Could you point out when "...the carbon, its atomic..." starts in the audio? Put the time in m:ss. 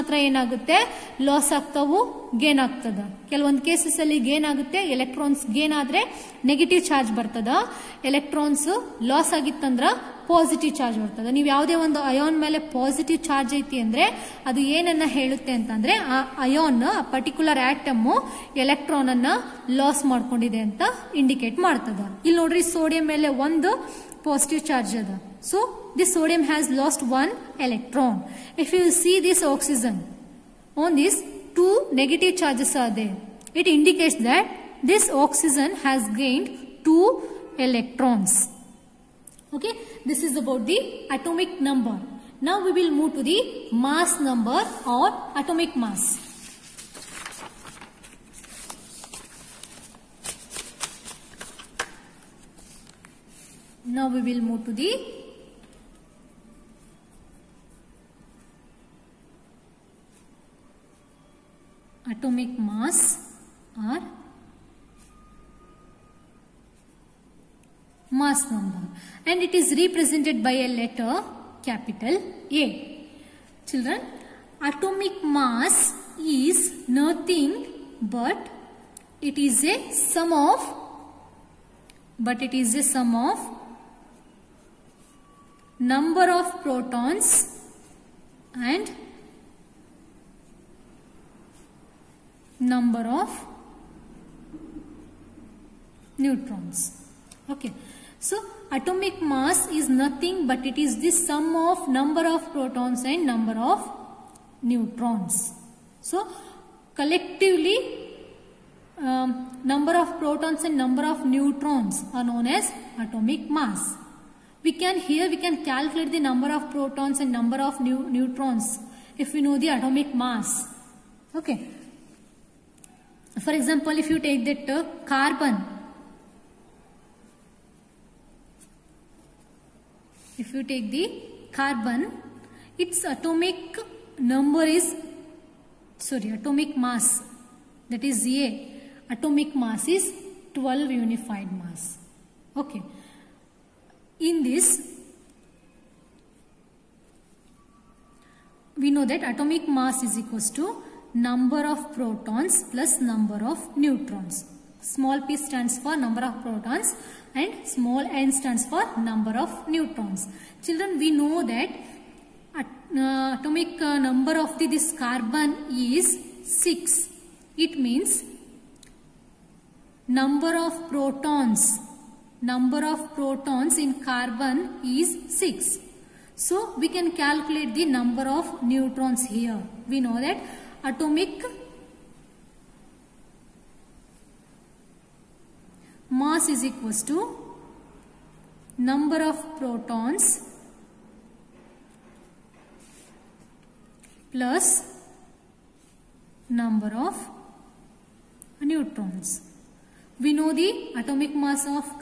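2:10.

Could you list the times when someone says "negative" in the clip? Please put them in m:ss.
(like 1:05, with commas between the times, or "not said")
0:31.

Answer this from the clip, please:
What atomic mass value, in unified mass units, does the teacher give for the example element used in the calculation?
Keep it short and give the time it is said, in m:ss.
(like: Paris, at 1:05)
12, at 2:20.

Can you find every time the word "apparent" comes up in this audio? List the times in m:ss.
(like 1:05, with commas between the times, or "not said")
not said.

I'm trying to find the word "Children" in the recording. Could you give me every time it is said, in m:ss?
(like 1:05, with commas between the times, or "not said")
1:13, 2:40.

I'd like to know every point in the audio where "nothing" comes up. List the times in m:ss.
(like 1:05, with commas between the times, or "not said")
1:16, 1:39.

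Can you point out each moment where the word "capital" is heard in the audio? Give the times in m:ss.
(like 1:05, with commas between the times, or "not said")
1:11.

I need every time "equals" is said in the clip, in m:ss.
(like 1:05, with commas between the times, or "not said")
2:30, 3:06.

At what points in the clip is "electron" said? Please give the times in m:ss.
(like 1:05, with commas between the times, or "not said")
0:27, 0:37.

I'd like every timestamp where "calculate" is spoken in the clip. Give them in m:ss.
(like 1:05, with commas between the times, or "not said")
1:55, 2:57.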